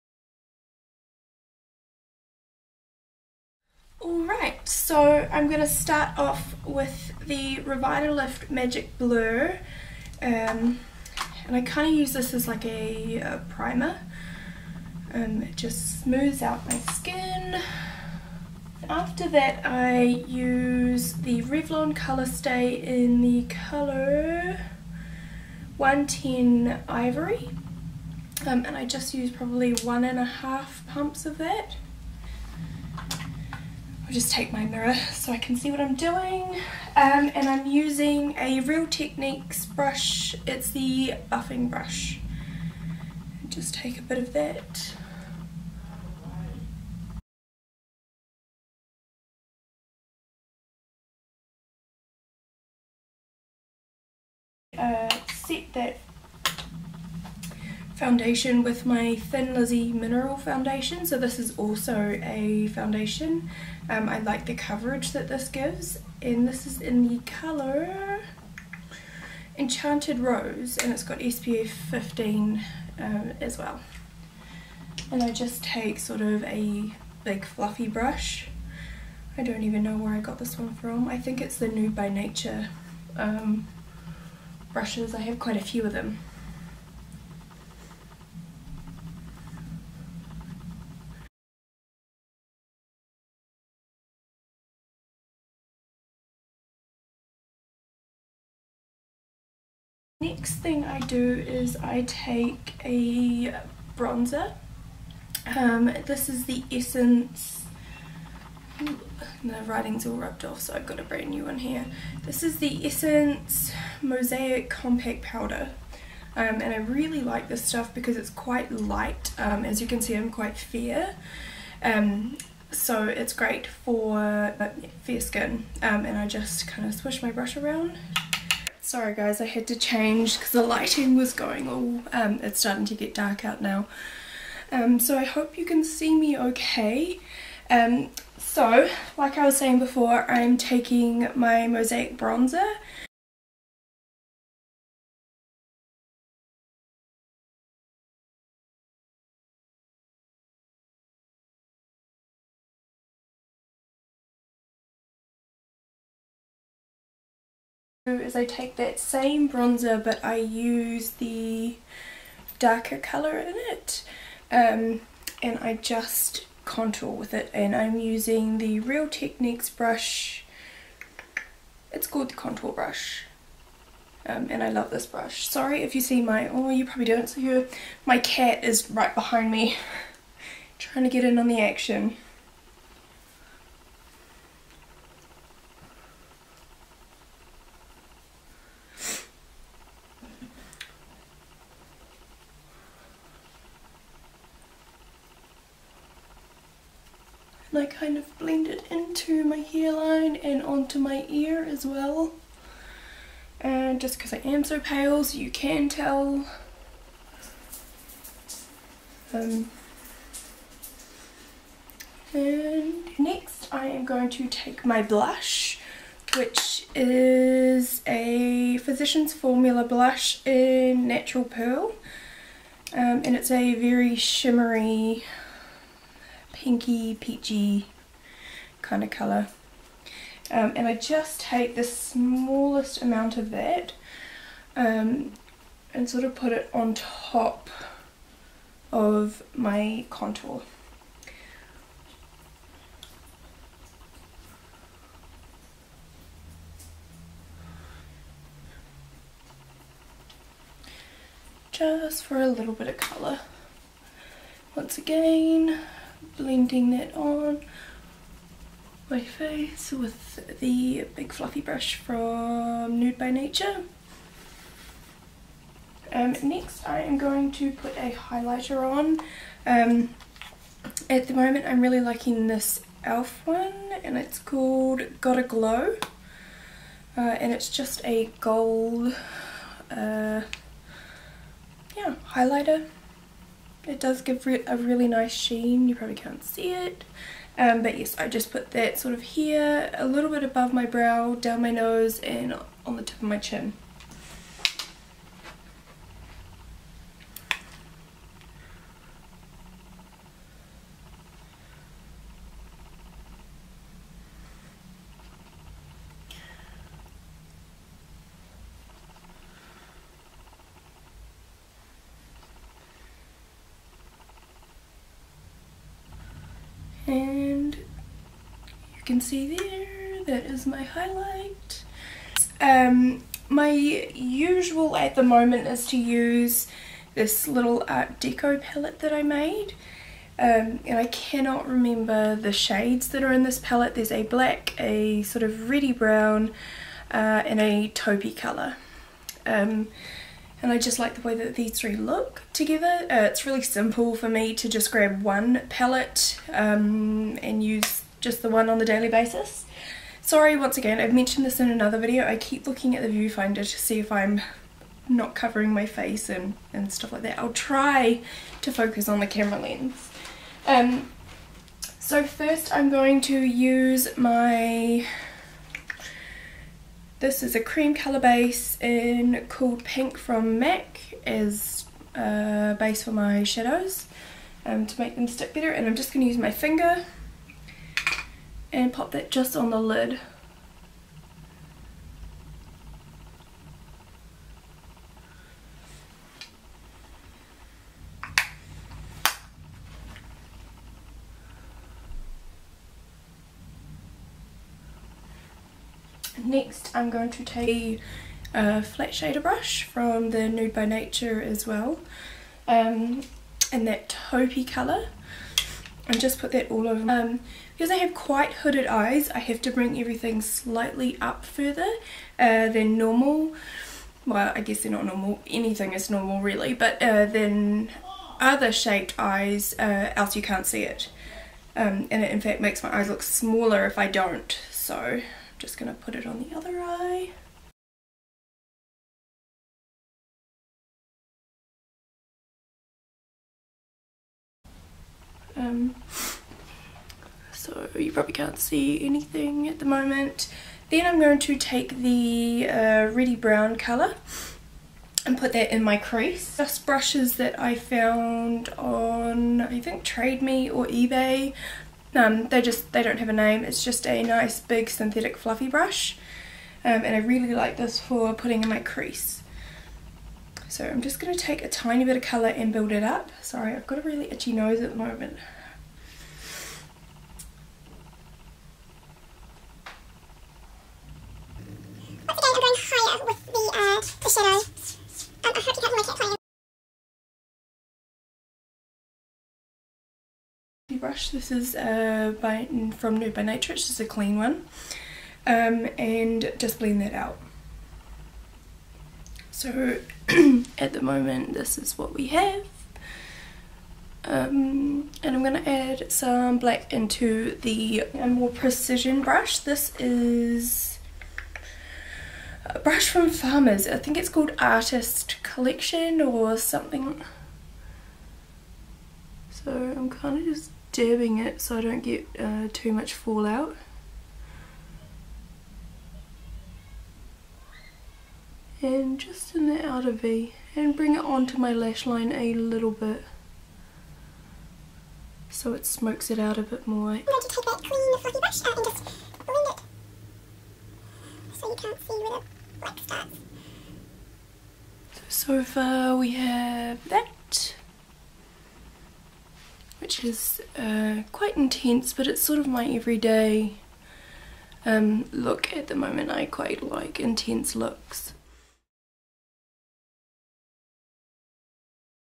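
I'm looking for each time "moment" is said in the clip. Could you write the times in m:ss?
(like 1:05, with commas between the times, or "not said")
4:31, 5:25, 7:19, 7:44, 8:11, 9:05.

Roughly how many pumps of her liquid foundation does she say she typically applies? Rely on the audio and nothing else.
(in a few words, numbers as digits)
1.5.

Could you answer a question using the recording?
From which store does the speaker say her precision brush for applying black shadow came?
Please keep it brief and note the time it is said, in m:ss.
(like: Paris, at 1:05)
Farmers, at 8:23.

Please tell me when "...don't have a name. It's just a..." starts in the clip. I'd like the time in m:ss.
7:33.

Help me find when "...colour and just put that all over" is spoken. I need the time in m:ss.
6:44.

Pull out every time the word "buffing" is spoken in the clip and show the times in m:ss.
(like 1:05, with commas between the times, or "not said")
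0:41.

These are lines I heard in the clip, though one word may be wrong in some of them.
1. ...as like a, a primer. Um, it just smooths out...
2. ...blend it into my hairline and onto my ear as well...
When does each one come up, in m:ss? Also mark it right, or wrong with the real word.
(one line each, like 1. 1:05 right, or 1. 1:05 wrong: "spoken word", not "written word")
1. 0:12 right
2. 3:18 right.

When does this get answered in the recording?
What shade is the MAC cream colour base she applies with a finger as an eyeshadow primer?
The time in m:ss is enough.
6:09.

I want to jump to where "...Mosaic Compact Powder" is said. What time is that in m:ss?
1:54.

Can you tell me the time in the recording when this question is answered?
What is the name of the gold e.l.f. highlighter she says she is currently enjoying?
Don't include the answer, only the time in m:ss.
4:35.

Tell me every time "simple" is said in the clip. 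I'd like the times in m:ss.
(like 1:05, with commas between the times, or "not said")
5:43.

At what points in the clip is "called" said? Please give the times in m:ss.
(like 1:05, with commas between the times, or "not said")
2:52, 4:34, 8:24.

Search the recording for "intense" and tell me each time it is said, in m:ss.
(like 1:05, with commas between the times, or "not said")
9:01, 9:07.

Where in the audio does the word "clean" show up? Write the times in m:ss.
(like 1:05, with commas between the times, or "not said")
8:04, 8:47.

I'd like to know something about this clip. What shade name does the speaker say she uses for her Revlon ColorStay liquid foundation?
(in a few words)
110 Ivory.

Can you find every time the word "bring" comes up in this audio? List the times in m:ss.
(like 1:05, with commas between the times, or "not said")
6:49, 8:40.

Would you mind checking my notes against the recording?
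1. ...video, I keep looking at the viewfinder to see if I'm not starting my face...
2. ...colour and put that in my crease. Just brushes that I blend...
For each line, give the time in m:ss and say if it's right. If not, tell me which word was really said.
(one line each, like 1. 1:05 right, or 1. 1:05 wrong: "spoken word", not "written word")
1. 5:51 wrong: "covering", not "starting"
2. 7:23 wrong: "found", not "blend".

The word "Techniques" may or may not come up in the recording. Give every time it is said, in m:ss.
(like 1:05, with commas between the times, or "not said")
0:38, 2:49.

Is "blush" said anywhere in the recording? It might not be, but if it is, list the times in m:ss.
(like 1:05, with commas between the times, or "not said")
3:35, 3:39.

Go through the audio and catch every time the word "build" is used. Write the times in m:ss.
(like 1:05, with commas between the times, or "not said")
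7:42.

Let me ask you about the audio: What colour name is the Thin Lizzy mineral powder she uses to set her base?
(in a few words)
Enchanted Rose.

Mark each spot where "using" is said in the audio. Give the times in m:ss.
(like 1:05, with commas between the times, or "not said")
0:37, 2:47.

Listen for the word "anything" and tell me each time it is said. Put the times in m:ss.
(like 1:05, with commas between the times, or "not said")
6:55, 7:19.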